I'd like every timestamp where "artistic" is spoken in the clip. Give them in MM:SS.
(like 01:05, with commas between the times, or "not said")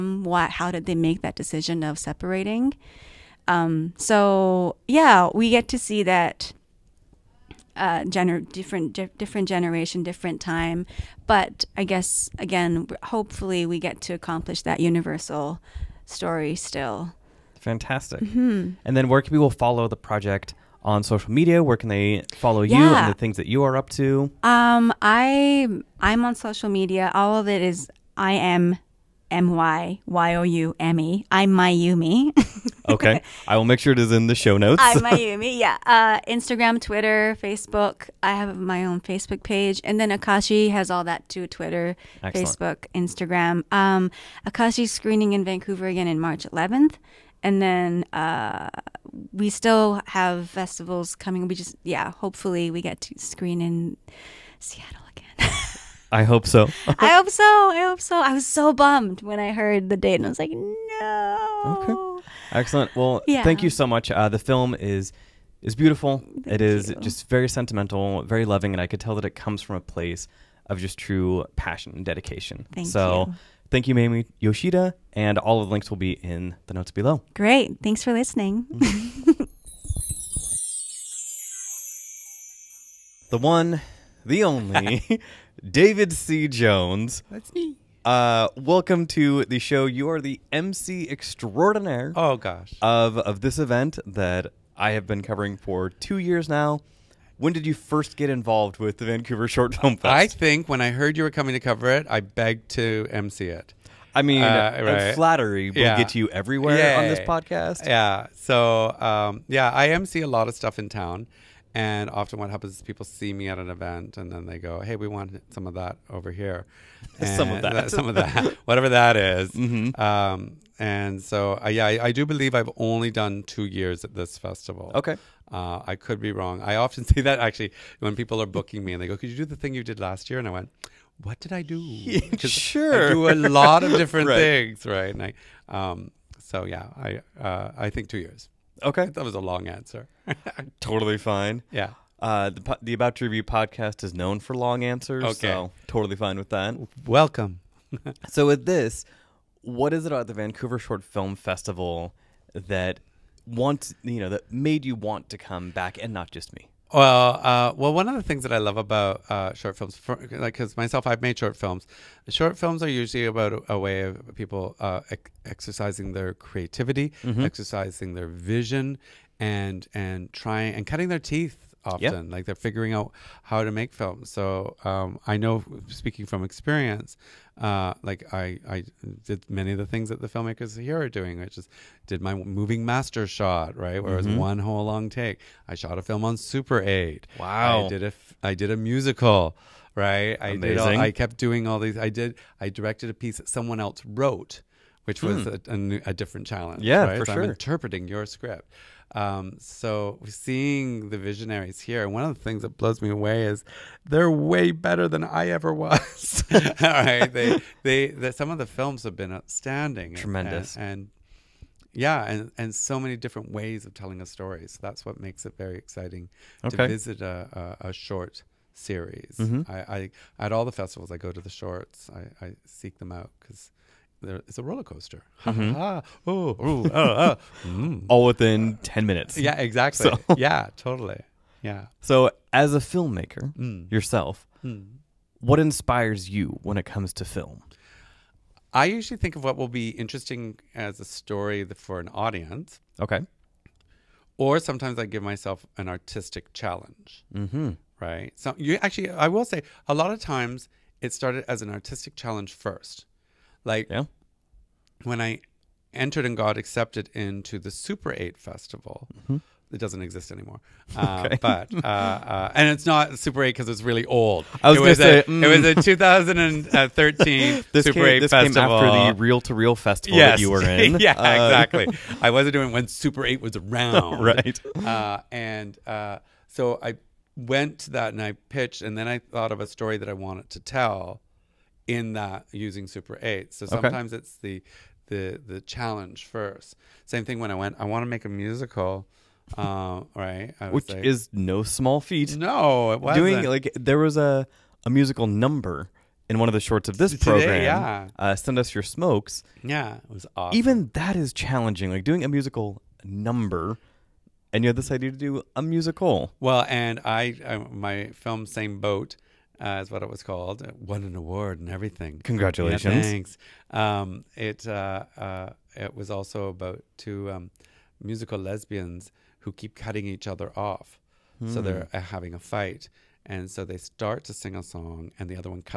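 04:05, 04:11.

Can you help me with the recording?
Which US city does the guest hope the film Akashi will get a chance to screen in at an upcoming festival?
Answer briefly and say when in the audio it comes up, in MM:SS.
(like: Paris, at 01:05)
Seattle, at 00:54.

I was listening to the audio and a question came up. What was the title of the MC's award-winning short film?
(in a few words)
Same Boat.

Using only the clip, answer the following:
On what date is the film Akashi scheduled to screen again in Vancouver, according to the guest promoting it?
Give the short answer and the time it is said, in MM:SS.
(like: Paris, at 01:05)
March 11, at 00:46.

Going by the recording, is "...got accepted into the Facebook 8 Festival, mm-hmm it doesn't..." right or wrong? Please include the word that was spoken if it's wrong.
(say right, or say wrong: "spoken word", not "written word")
wrong: "Super", not "Facebook".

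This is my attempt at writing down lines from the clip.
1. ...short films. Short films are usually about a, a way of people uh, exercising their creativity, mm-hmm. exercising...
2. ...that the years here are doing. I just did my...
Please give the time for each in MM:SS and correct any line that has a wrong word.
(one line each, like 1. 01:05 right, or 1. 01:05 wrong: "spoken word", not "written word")
1. 02:41 right
2. 03:00 wrong: "filmmakers", not "years".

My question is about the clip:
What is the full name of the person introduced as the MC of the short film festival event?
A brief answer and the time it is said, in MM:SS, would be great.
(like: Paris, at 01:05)
David C. Jones, at 01:25.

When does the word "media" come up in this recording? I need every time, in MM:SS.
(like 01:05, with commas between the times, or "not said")
00:21, 00:26.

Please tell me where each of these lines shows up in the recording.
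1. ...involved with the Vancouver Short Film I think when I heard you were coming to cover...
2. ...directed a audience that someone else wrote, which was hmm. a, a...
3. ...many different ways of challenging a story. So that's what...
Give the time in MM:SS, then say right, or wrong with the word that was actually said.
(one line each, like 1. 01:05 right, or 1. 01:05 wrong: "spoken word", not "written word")
1. 01:38 right
2. 03:12 wrong: "piece", not "audience"
3. 03:32 wrong: "telling", not "challenging".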